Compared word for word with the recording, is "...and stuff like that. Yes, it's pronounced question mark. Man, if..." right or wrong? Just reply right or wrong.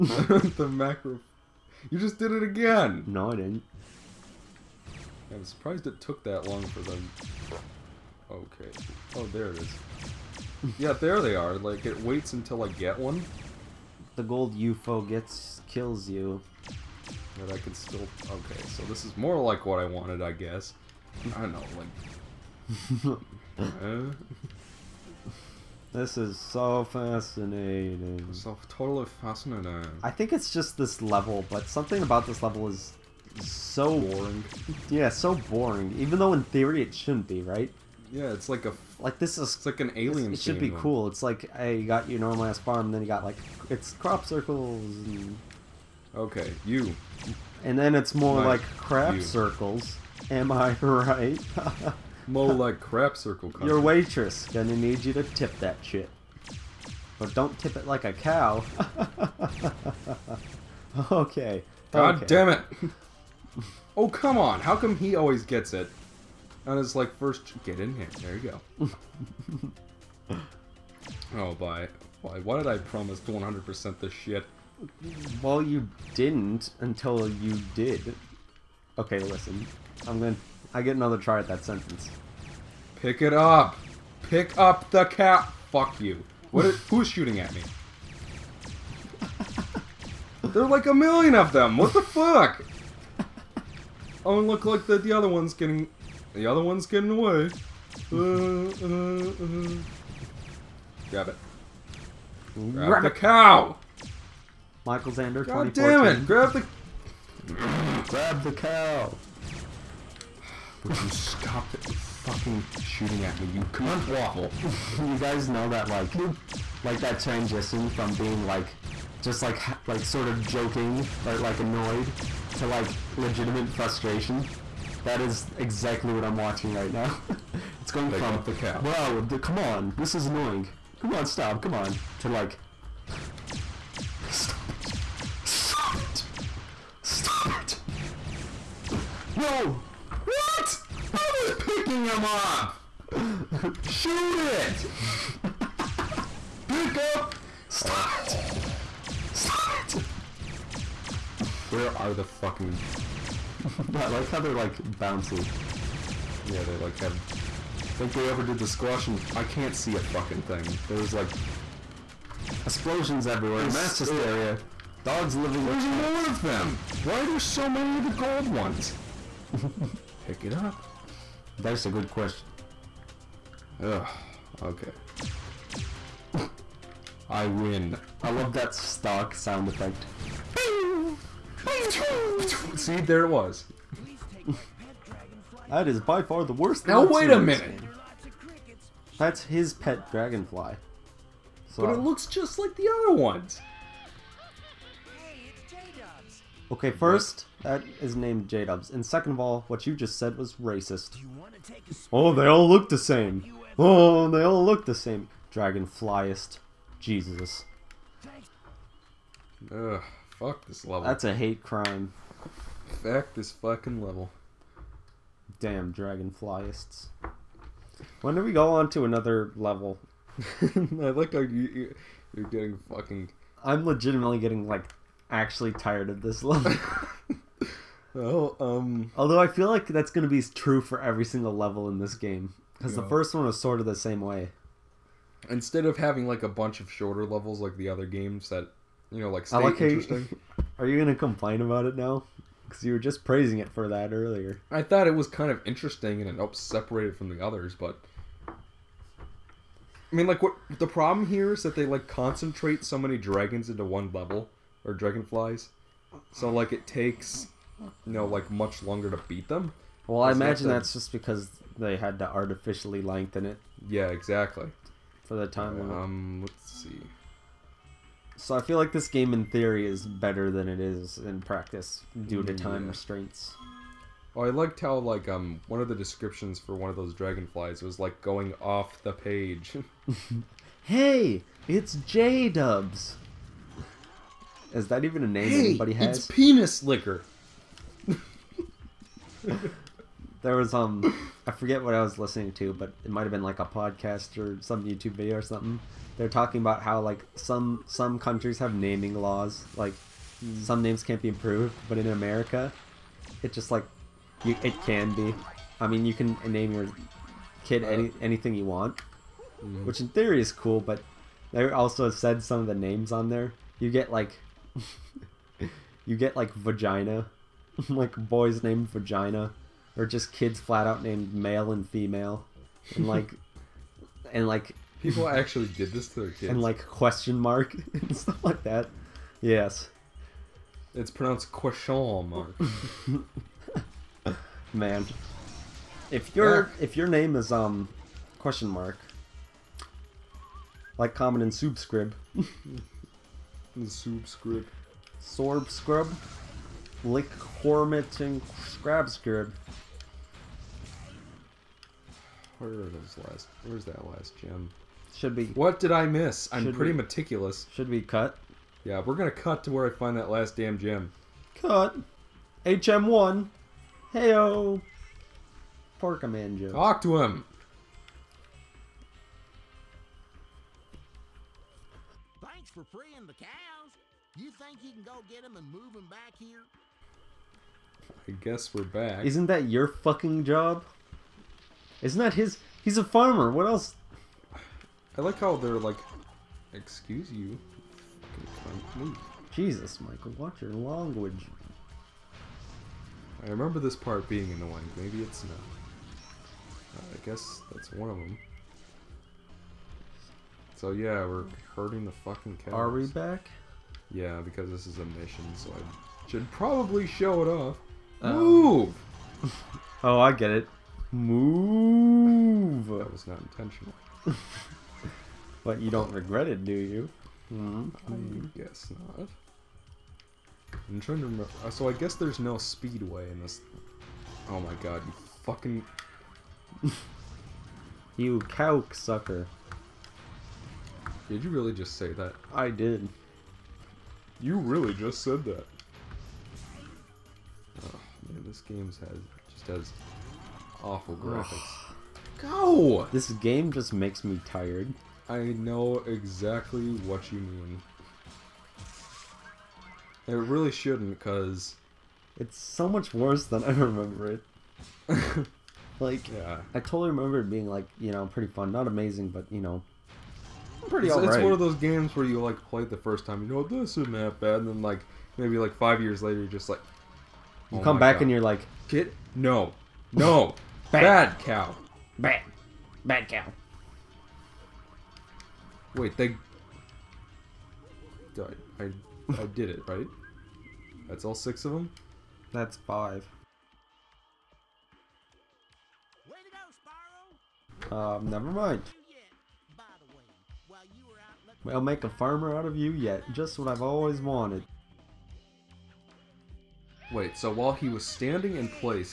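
right.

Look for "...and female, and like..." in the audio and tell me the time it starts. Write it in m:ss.
5:21.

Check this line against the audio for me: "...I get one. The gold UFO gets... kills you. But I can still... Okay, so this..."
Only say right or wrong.
right.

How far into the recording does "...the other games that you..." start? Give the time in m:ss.
3:57.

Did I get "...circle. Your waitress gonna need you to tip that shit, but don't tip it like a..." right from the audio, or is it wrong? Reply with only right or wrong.
right.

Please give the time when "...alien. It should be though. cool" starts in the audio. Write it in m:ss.
0:39.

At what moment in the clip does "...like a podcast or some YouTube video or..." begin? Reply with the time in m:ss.
4:53.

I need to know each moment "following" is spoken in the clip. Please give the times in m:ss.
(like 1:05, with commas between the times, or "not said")
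not said.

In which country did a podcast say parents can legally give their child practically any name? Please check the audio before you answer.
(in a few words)
America.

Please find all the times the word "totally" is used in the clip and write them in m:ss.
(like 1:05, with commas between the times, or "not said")
0:28, 7:36.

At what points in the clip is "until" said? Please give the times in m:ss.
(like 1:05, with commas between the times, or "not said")
0:12, 1:16.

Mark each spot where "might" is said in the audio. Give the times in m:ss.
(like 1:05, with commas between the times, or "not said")
4:53.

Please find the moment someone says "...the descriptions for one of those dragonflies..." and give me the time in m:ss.
4:35.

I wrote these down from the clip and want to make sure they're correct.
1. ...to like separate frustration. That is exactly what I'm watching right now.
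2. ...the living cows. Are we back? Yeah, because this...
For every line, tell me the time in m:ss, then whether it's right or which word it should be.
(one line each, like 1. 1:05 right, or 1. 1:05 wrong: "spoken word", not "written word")
1. 2:02 wrong: "legitimate", not "separate"
2. 6:42 wrong: "fucking", not "living".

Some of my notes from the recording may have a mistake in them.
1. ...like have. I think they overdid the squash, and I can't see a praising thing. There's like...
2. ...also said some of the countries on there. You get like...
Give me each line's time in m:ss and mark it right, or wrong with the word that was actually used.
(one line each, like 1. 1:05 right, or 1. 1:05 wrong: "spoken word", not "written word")
1. 2:36 wrong: "fucking", not "praising"
2. 5:11 wrong: "names", not "countries".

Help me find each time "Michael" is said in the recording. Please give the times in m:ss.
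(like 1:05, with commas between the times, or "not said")
1:44, 6:30.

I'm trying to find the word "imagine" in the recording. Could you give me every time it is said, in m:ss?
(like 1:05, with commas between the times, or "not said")
4:20.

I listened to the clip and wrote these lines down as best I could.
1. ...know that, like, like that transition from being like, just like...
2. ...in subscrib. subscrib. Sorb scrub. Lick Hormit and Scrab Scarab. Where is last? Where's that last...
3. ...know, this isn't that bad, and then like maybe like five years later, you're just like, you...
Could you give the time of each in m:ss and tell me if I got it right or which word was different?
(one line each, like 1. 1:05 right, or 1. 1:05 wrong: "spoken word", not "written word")
1. 1:55 right
2. 5:41 right
3. 7:43 right.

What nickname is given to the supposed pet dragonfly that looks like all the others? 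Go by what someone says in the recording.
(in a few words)
J-Dubs.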